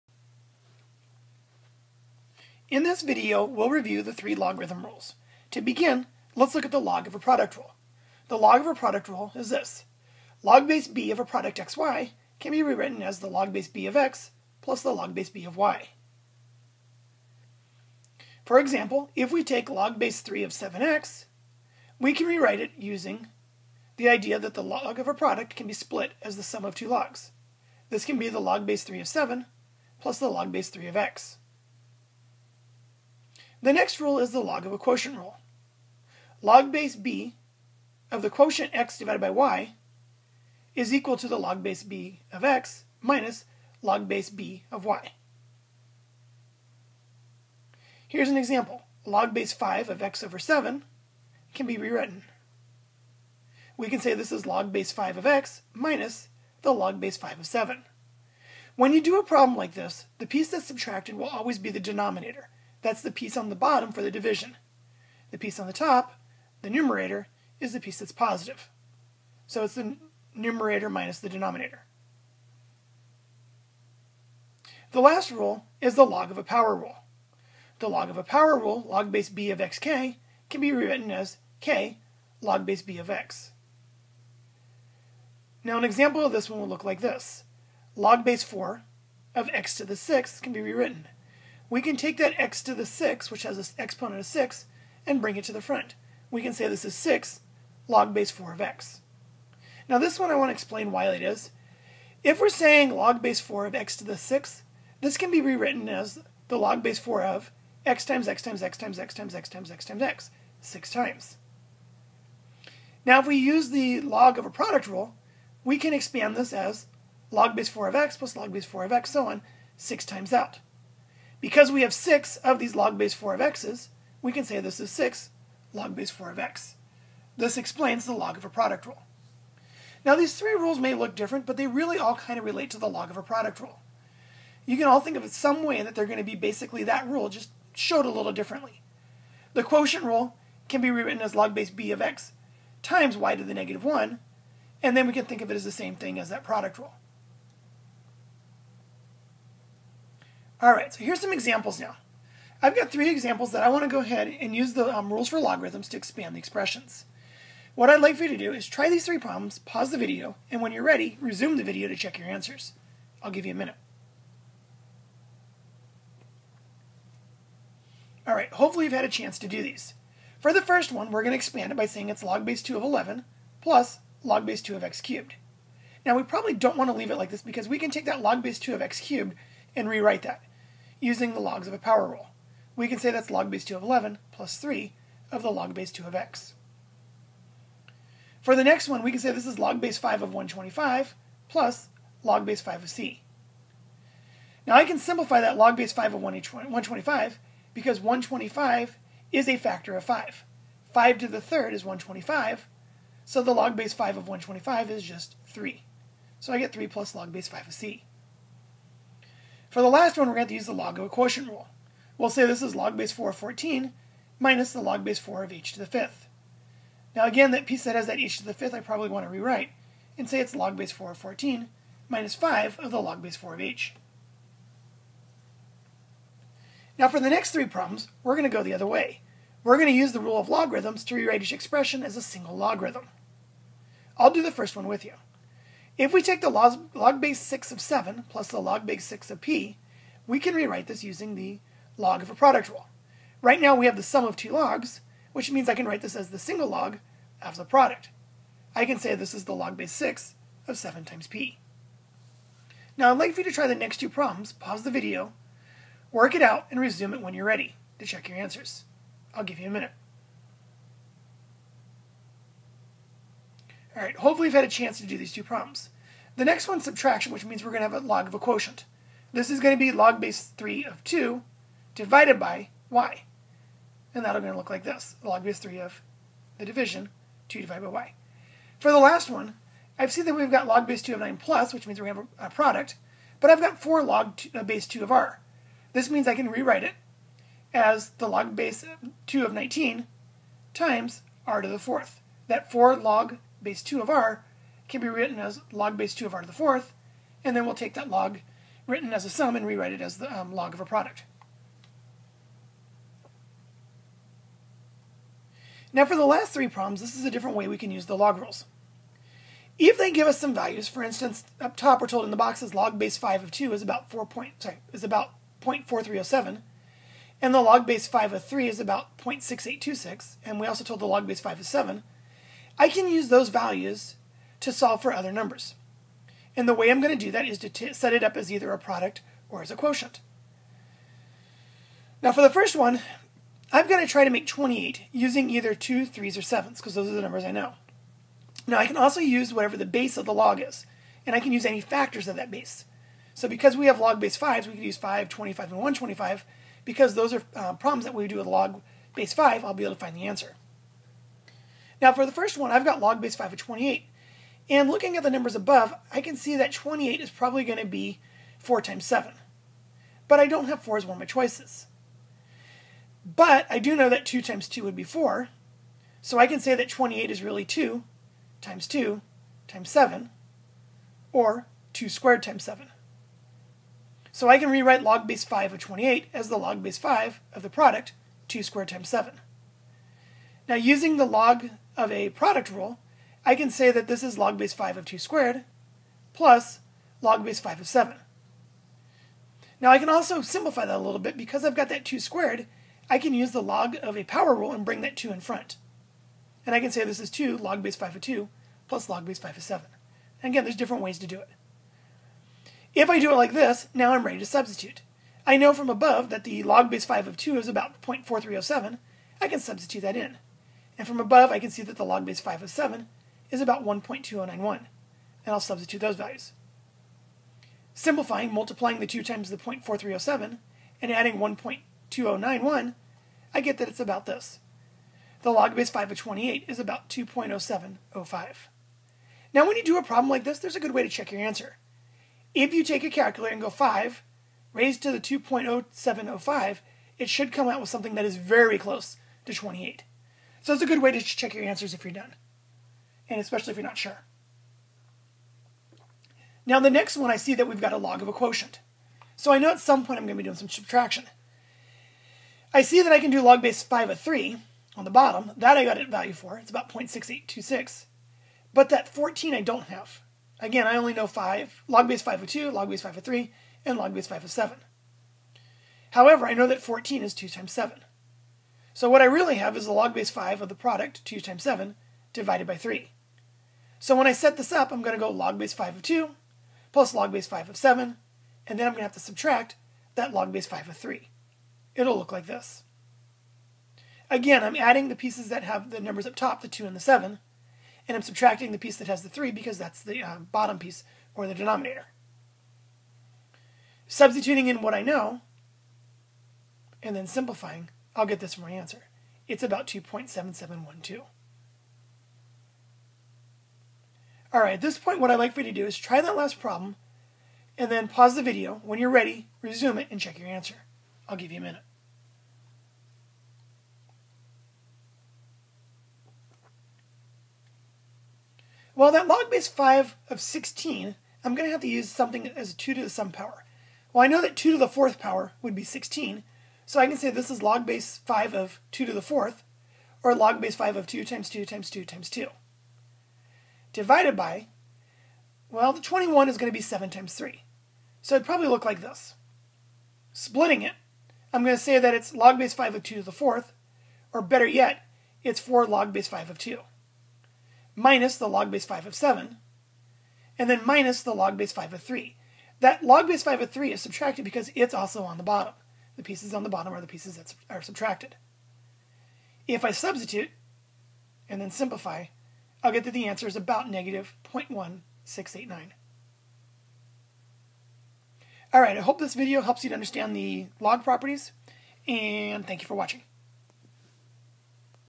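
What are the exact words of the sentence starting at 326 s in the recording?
And the way I'm going to do that is to set it up as either a product or as a quotient.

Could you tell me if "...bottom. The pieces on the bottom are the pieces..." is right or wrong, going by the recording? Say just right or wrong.
right.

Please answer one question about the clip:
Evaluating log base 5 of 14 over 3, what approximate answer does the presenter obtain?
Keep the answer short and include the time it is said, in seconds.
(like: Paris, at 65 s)
2.7712, at 499 s.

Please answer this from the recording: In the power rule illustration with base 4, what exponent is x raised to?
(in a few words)
6.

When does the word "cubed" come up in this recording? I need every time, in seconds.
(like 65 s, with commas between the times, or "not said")
175 s, 179 s.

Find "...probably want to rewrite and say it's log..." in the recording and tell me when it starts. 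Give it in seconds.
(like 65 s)
218 s.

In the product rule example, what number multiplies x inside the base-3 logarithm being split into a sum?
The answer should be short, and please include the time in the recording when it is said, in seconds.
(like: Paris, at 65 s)
7, at 20 s.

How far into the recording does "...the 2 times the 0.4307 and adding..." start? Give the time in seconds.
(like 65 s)
418 s.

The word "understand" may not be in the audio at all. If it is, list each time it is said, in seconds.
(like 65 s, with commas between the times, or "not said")
569 s.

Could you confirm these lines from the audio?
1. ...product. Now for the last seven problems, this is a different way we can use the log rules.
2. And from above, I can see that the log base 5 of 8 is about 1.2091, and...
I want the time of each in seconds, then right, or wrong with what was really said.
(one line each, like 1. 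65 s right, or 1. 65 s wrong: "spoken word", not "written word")
1. 300 s wrong: "three", not "seven"
2. 410 s wrong: "7", not "8".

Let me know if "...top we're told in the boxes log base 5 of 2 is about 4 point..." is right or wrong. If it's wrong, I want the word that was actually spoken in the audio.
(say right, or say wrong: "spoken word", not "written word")
right.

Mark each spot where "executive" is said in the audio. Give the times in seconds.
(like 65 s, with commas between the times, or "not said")
not said.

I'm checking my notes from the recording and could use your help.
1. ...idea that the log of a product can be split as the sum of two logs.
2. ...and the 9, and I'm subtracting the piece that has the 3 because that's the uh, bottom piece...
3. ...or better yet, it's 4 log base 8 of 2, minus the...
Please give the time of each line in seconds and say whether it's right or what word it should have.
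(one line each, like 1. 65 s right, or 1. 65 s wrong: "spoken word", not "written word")
1. 24 s right
2. 486 s wrong: "7", not "9"
3. 544 s wrong: "5", not "8".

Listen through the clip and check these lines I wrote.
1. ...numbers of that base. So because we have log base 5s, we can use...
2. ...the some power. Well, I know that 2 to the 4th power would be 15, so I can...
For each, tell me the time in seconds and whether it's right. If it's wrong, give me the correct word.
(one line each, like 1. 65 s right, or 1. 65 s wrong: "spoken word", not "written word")
1. 341 s wrong: "factors", not "numbers"
2. 523 s wrong: "16", not "15".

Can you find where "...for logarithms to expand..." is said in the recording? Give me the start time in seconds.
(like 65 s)
155 s.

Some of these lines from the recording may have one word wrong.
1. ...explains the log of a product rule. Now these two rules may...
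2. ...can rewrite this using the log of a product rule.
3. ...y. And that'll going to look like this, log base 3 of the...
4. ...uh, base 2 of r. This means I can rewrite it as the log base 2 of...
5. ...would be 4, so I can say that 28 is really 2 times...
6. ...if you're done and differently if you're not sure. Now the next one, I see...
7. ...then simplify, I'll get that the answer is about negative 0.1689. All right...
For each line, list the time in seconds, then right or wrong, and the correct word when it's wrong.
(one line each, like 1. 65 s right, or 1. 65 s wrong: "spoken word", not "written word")
1. 127 s wrong: "three", not "two"
2. 240 s right
3. 272 s right
4. 284 s right
5. 364 s right
6. 441 s wrong: "especially", not "differently"
7. 561 s right.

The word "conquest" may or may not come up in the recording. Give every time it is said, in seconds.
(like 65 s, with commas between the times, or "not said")
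not said.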